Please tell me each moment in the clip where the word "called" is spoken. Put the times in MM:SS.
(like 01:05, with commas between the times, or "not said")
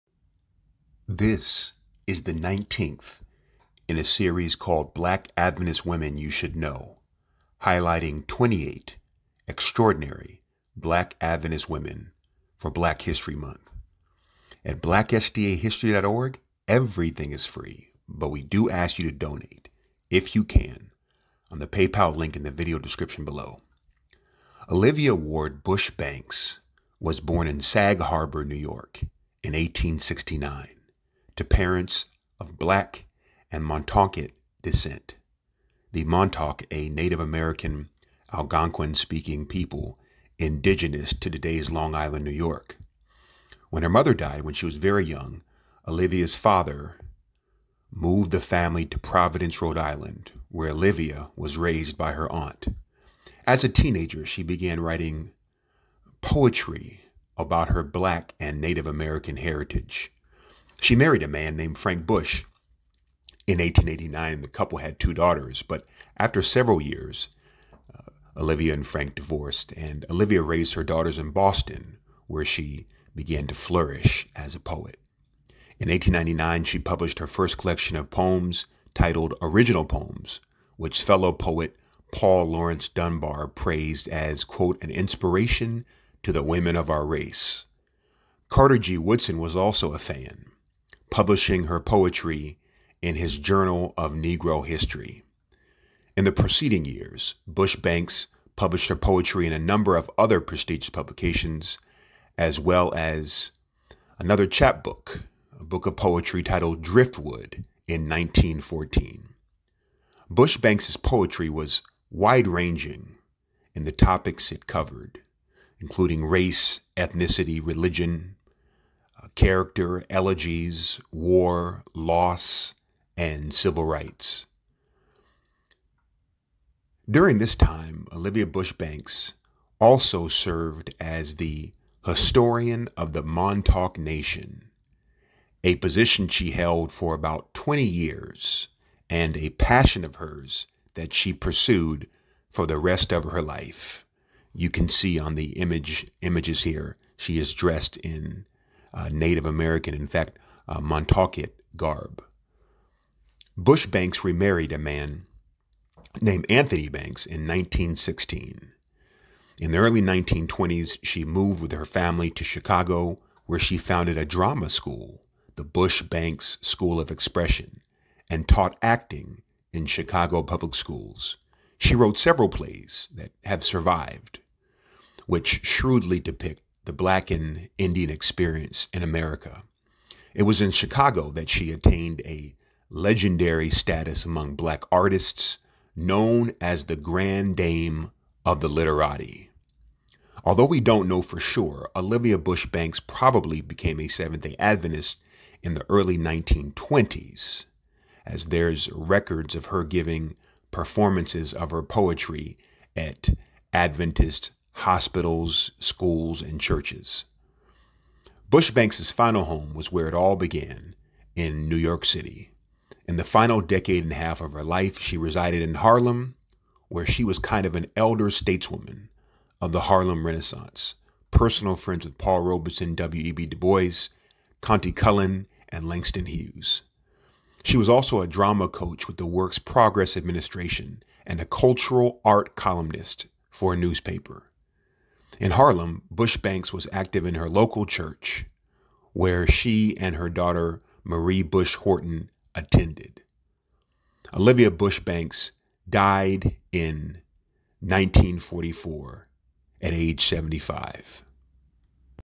00:04.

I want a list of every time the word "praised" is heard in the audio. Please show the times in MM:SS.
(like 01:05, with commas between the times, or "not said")
01:23.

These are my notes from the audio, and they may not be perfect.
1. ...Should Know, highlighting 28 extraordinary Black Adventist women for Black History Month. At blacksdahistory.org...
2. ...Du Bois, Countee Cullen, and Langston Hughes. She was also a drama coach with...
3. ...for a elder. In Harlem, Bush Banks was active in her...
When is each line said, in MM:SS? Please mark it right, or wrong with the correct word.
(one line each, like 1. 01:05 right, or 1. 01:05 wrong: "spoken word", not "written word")
1. 00:06 right
2. 03:43 right
3. 03:53 wrong: "newspaper", not "elder".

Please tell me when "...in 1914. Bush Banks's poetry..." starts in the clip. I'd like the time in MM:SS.
01:47.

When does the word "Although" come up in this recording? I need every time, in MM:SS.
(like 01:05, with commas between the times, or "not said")
03:10.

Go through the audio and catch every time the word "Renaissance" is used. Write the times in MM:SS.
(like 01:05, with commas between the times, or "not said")
03:40.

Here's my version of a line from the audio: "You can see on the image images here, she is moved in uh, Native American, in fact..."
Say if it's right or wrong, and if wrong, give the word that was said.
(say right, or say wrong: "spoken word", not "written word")
wrong: "dressed", not "moved".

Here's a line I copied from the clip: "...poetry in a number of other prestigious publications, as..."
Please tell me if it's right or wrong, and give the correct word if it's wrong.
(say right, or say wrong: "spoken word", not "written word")
right.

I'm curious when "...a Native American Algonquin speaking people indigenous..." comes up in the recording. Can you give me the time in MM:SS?
00:36.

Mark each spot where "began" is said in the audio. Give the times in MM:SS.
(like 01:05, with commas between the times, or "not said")
00:54, 01:13, 03:30.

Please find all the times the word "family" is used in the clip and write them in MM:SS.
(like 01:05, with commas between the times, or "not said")
00:48, 02:41.